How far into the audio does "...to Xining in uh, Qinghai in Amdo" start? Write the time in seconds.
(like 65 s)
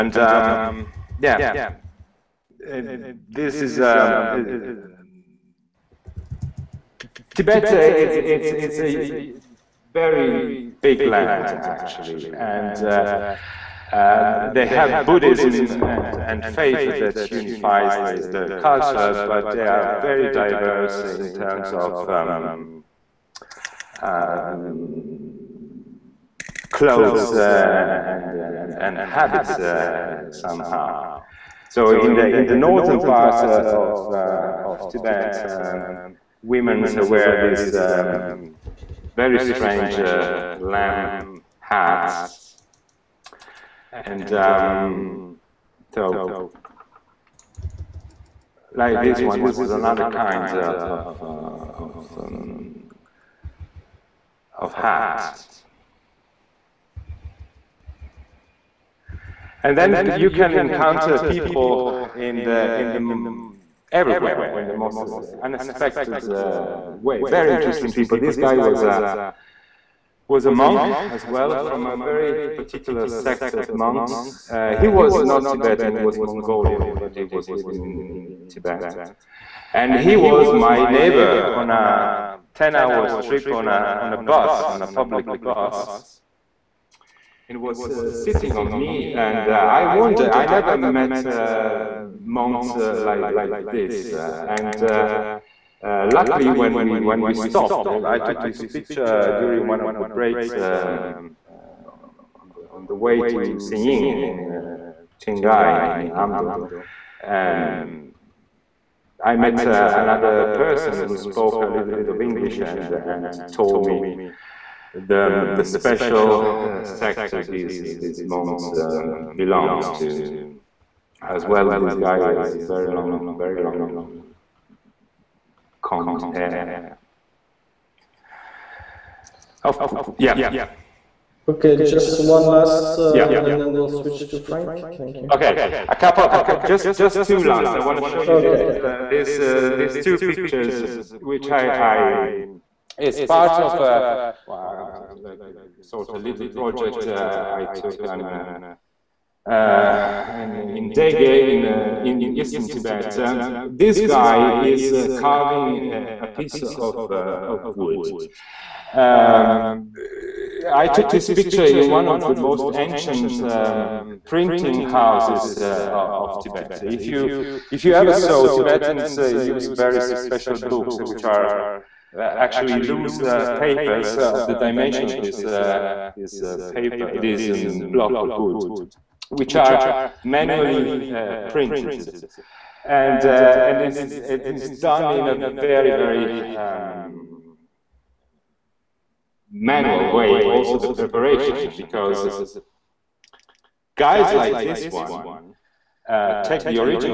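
103 s.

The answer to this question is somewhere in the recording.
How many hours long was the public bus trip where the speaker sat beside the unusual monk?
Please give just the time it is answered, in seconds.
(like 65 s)
82 s.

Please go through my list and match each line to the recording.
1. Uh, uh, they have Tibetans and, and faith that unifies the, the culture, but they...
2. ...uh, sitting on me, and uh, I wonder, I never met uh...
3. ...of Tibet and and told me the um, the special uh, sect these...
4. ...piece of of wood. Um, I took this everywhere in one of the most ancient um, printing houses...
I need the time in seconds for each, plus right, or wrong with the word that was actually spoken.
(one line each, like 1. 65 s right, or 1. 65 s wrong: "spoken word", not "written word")
1. 12 s wrong: "Buddhism", not "Tibetans"
2. 87 s right
3. 112 s wrong: "English", not "Tibet"
4. 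156 s wrong: "picture", not "everywhere".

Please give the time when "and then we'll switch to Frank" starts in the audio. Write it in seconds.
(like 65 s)
133 s.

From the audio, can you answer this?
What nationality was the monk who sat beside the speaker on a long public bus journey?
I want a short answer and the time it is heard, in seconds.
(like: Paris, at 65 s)
Mongolian, at 76 s.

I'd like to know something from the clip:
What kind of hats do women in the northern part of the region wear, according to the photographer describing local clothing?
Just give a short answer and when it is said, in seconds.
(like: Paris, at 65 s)
Lamb hats, at 39 s.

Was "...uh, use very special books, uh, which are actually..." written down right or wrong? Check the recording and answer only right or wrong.
right.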